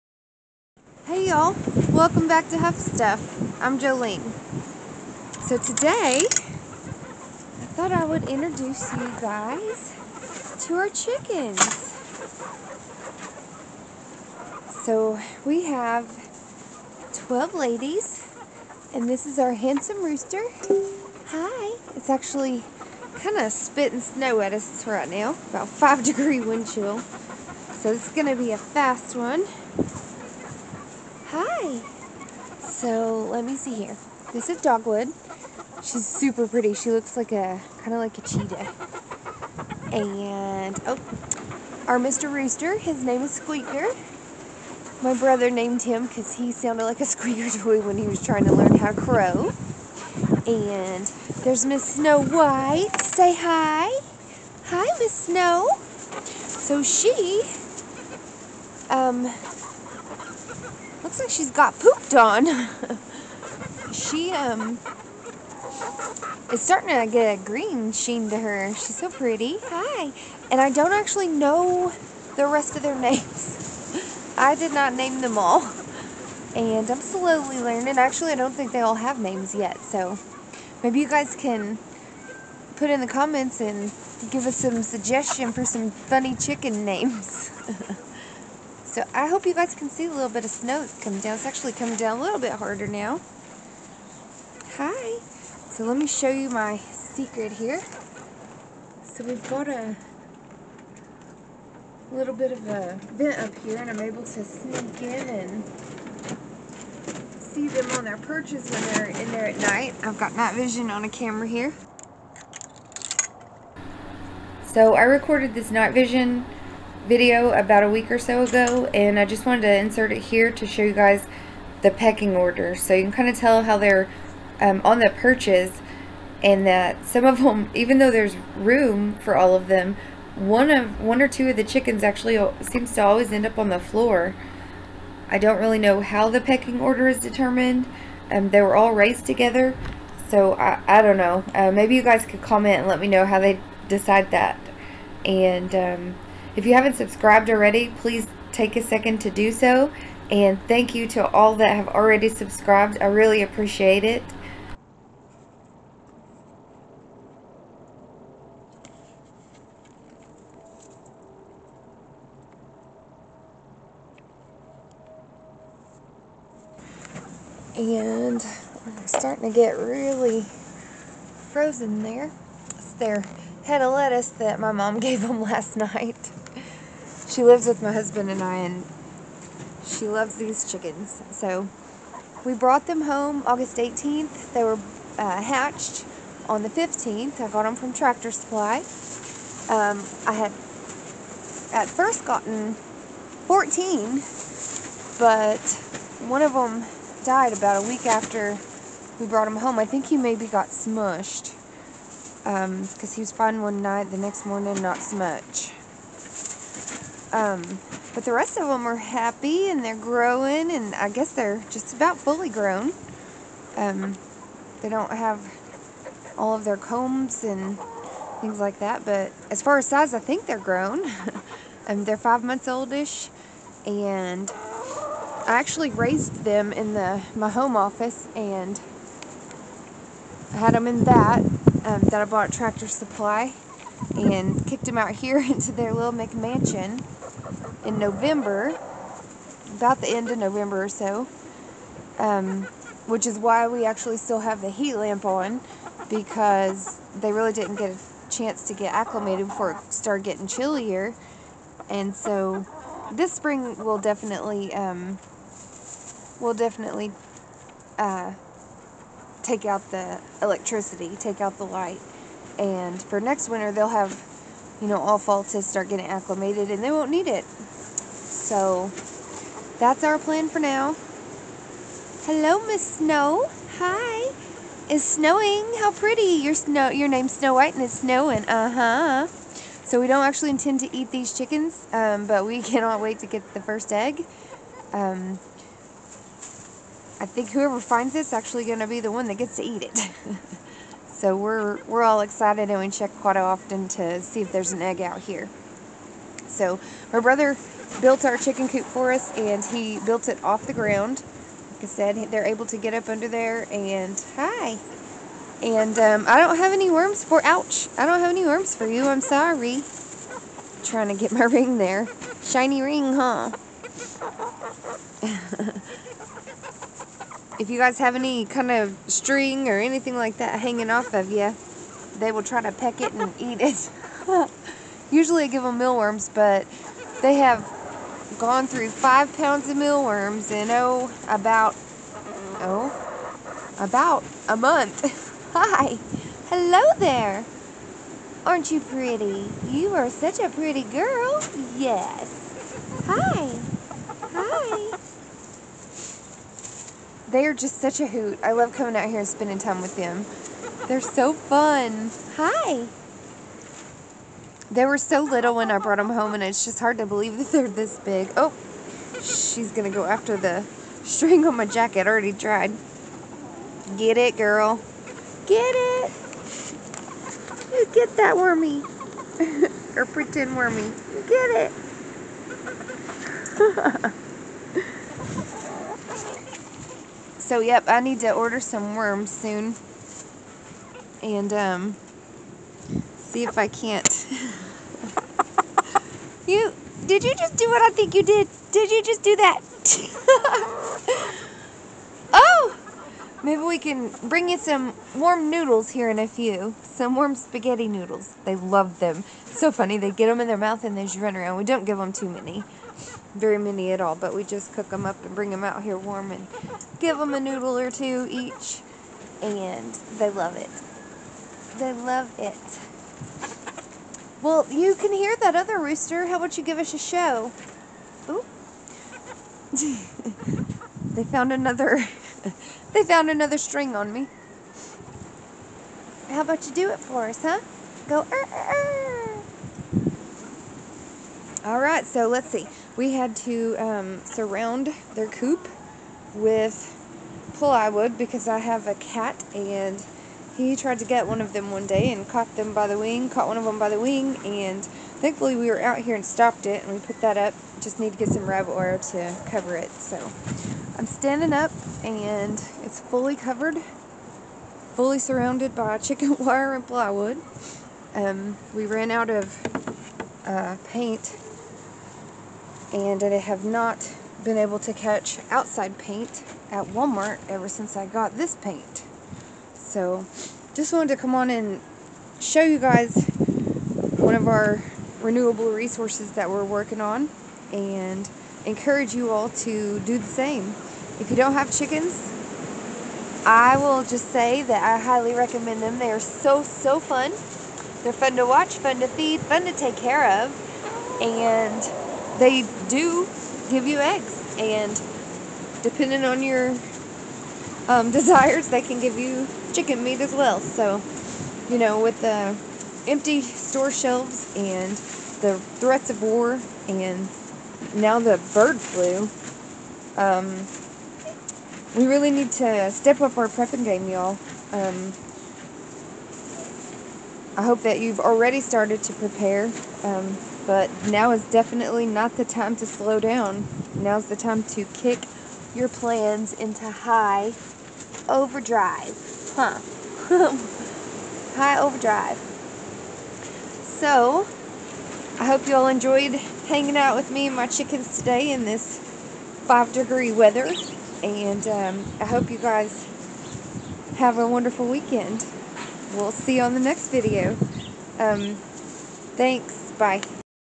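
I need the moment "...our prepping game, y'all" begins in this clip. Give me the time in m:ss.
8:33.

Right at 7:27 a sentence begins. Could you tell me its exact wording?
Just need to get some reverend oil to cover it.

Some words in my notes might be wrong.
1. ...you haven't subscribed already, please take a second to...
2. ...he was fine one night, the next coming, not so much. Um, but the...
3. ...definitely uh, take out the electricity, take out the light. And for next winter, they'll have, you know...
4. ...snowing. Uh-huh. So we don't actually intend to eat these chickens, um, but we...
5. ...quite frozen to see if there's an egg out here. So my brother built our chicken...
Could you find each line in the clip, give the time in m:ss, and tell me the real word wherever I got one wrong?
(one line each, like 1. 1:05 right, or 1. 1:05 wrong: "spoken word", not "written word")
1. 2:26 right
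2. 3:23 wrong: "morning", not "coming"
3. 4:16 right
4. 4:37 right
5. 4:53 wrong: "often", not "frozen".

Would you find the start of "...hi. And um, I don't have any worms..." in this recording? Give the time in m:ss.
5:04.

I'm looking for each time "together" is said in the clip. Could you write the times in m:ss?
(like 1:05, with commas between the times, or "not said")
2:19.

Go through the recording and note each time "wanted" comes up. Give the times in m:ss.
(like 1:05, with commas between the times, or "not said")
1:59, 7:50.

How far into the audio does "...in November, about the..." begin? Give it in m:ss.
3:57.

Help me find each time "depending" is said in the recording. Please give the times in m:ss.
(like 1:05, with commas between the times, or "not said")
8:15.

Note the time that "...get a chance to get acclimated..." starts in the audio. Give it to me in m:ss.
4:07.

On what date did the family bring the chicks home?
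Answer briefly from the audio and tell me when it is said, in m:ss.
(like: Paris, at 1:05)
August 18th, at 3:03.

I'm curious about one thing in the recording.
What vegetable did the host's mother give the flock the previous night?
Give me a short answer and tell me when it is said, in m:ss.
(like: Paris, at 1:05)
Lettuce, at 2:53.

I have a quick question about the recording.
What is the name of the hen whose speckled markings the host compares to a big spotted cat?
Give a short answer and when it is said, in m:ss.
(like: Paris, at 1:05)
Dogwood, at 0:34.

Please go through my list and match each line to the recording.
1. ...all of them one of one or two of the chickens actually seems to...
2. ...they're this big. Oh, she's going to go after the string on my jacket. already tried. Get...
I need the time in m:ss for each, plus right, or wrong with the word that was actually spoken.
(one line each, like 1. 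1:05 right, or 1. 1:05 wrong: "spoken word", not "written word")
1. 2:09 right
2. 5:57 right.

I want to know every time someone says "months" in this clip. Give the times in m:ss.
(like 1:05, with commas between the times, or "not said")
3:42, 5:34.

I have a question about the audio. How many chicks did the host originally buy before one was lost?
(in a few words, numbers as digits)
14.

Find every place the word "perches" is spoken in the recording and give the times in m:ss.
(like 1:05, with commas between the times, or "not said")
1:48, 2:05.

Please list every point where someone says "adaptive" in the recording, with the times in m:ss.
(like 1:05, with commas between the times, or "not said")
not said.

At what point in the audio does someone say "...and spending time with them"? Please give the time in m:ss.
5:49.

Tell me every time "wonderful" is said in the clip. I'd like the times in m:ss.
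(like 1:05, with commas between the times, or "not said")
9:04.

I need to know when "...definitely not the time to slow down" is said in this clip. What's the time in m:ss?
8:41.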